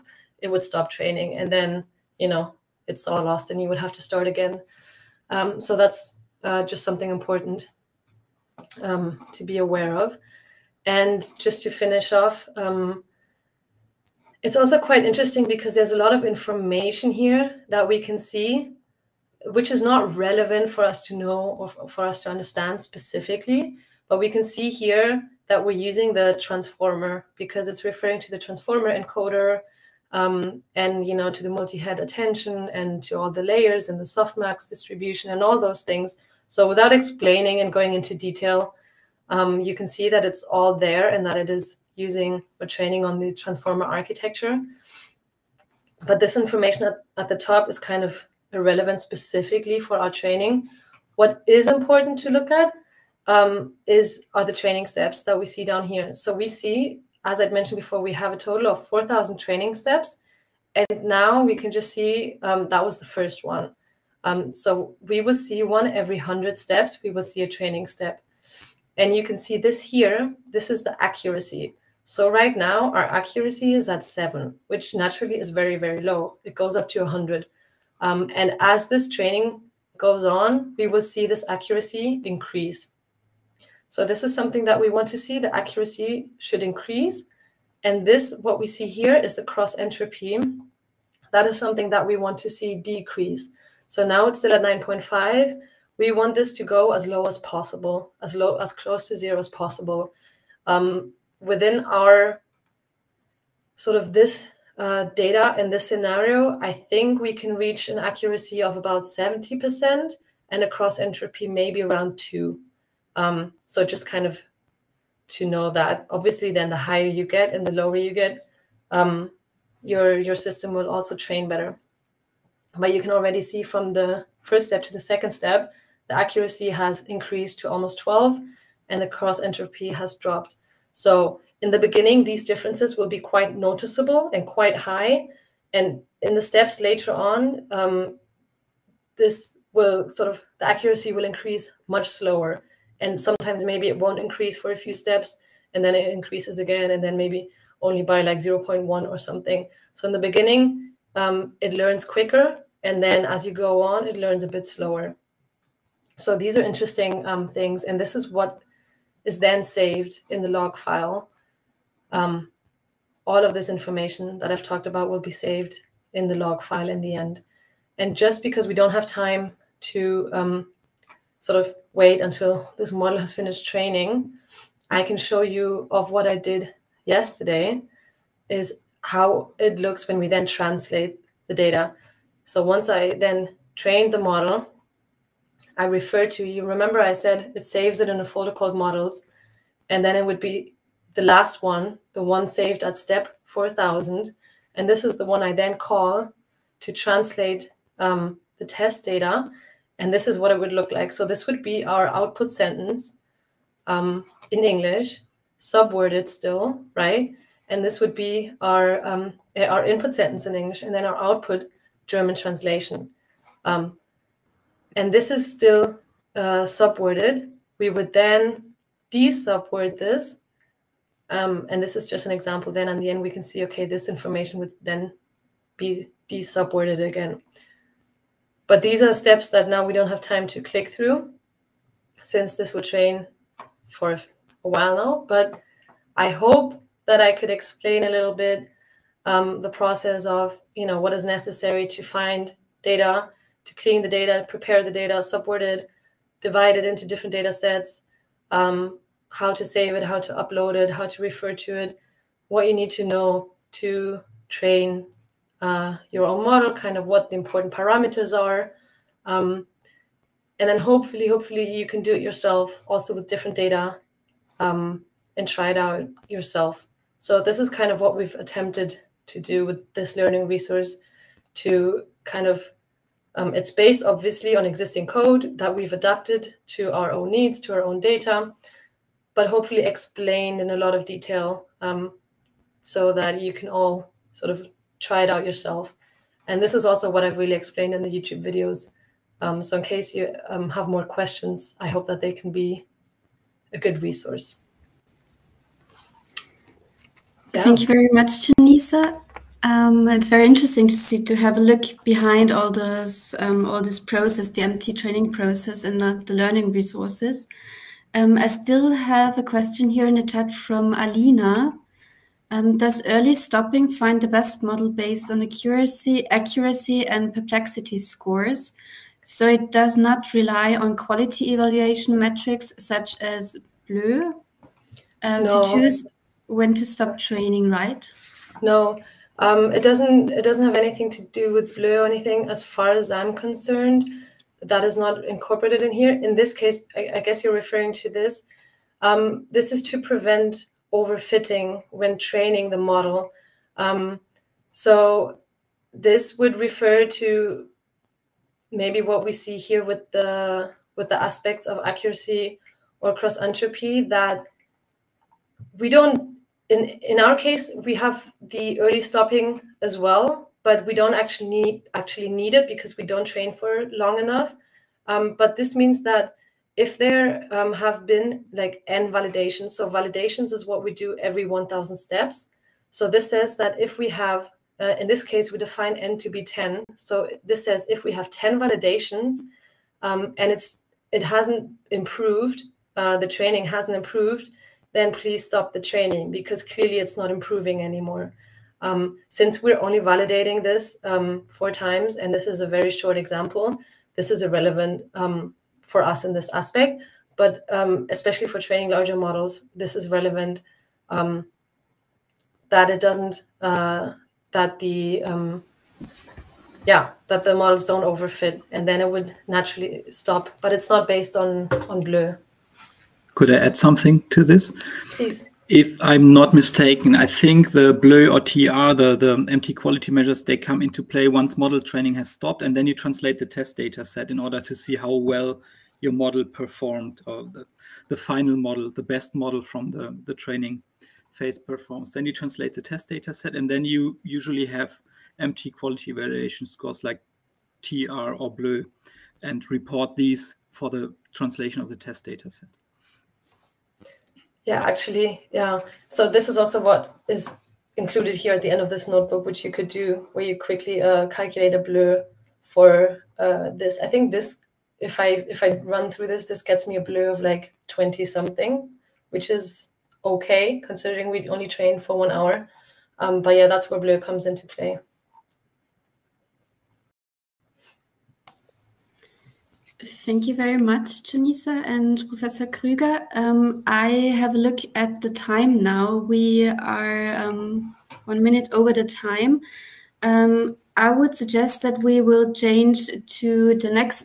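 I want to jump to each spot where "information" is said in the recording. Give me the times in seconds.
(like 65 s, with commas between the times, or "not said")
16 s, 46 s, 163 s, 224 s.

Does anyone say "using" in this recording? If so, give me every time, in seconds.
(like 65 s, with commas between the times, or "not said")
25 s, 41 s.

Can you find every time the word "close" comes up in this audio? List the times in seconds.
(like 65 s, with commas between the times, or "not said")
98 s.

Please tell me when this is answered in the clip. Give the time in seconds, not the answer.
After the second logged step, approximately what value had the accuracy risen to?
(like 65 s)
127 s.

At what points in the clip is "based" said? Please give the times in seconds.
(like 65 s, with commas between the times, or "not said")
273 s, 314 s, 411 s.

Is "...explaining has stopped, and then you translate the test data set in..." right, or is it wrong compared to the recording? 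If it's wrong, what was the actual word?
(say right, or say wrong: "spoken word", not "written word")
wrong: "training", not "explaining".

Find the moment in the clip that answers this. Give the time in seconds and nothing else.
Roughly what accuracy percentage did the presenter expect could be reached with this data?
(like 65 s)
109 s.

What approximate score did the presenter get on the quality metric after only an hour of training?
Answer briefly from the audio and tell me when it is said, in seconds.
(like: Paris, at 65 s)
20 something, at 457 s.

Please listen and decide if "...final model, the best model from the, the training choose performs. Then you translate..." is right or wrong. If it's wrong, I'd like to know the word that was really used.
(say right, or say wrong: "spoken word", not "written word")
wrong: "phase", not "choose".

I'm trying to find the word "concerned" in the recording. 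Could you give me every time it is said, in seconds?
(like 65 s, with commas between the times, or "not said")
333 s.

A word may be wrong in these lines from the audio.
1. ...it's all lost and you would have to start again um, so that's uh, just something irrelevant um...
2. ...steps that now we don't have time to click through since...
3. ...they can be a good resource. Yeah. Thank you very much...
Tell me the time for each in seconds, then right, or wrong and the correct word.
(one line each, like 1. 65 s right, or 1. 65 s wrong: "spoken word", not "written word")
1. 2 s wrong: "important", not "irrelevant"
2. 229 s right
3. 292 s right.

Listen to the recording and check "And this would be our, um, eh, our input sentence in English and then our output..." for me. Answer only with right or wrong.
right.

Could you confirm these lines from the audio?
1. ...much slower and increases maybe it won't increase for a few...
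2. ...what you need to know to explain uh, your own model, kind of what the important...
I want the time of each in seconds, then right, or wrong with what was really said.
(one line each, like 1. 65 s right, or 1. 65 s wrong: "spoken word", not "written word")
1. 141 s wrong: "sometimes", not "increases"
2. 252 s wrong: "train", not "explain".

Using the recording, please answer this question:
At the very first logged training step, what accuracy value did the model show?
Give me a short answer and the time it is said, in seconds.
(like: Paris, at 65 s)
7, at 74 s.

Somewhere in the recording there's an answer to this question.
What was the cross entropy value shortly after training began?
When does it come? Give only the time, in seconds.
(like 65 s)
94 s.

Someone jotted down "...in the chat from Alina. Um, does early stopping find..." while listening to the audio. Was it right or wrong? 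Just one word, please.
right.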